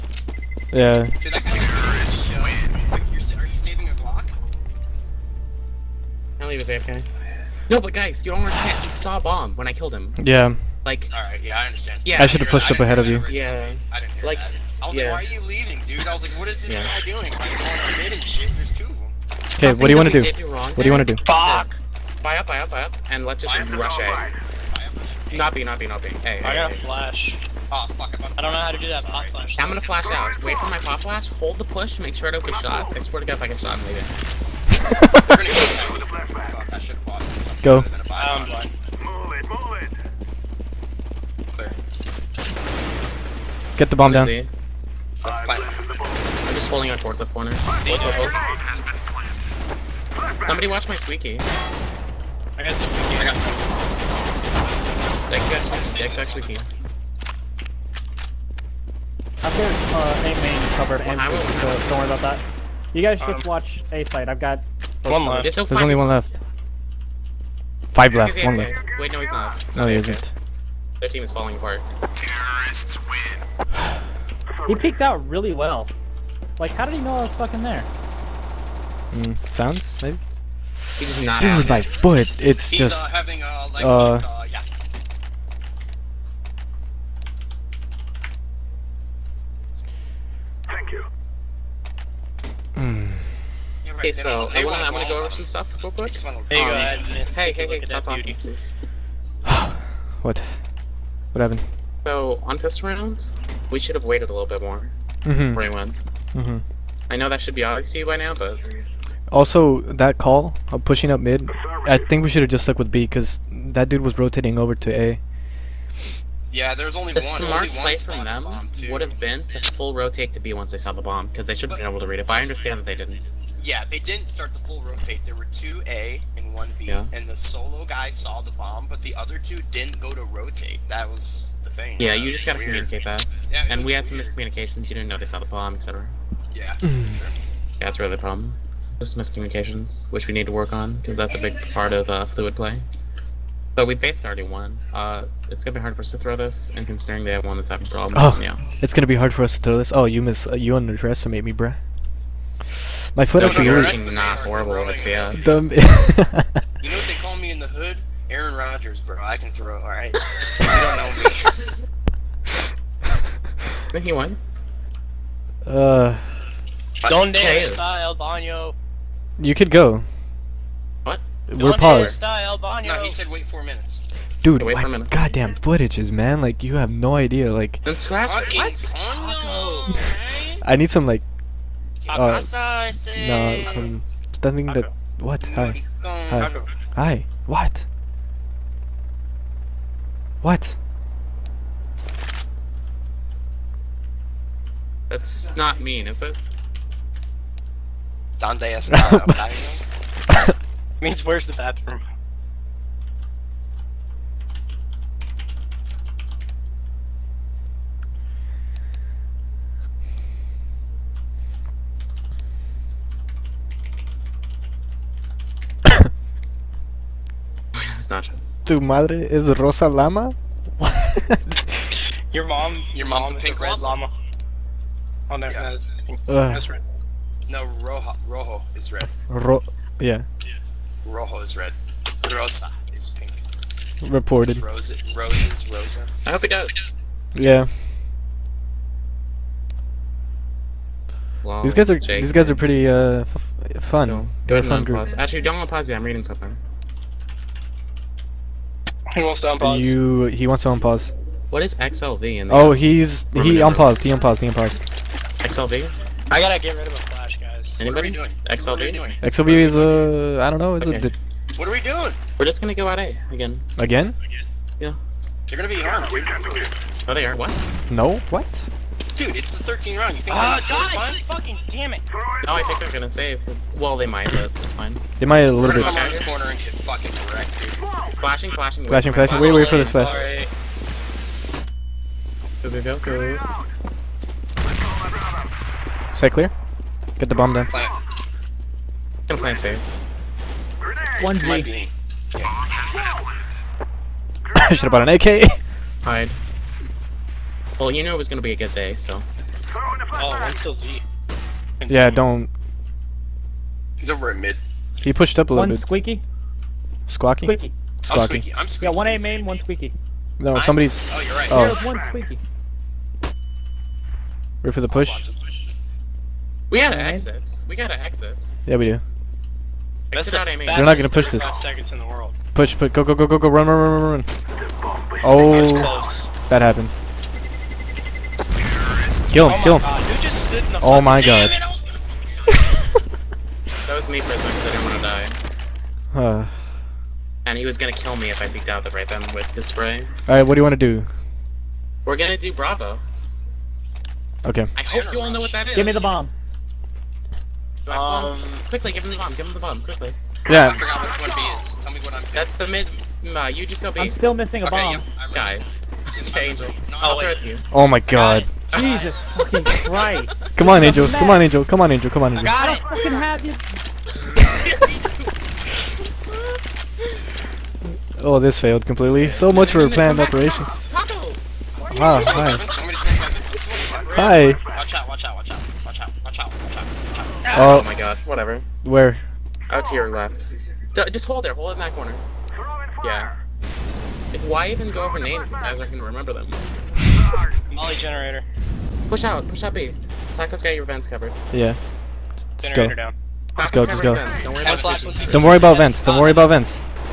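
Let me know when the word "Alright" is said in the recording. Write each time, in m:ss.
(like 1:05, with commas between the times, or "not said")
0:11, 4:40, 5:40.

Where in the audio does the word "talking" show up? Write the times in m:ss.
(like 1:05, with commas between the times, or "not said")
1:38.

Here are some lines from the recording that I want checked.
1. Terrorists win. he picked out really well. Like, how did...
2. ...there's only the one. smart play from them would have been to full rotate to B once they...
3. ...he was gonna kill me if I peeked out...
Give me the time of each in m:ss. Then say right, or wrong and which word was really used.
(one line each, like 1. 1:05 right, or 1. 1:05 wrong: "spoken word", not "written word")
1. 1:12 right
2. 1:56 right
3. 5:37 right.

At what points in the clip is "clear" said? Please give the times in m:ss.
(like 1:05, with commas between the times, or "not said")
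0:41, 4:46.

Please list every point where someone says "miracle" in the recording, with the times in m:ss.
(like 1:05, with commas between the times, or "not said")
not said.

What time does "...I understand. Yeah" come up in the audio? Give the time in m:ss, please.
0:11.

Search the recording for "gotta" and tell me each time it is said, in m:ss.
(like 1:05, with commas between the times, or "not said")
2:12, 4:16.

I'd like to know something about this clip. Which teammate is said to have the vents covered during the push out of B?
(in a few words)
Taco.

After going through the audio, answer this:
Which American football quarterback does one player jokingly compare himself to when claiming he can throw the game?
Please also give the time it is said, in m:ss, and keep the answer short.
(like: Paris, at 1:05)
Aaron Rodgers, at 2:38.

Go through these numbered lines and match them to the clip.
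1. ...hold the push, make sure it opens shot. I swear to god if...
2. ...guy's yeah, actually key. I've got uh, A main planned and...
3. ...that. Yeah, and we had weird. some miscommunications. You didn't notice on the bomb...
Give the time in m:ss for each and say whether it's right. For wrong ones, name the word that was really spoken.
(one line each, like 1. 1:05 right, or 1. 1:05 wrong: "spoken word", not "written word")
1. 0:31 right
2. 0:55 wrong: "covered", not "planned"
3. 2:13 right.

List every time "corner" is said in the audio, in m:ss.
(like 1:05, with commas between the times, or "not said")
0:47, 4:36, 6:21.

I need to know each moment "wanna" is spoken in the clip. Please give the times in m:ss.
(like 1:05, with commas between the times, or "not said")
1:34.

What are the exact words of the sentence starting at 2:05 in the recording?
There were two A and one B, yeah.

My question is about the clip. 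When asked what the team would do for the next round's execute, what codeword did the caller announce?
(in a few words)
Bravo.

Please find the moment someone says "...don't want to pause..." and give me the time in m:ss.
4:05.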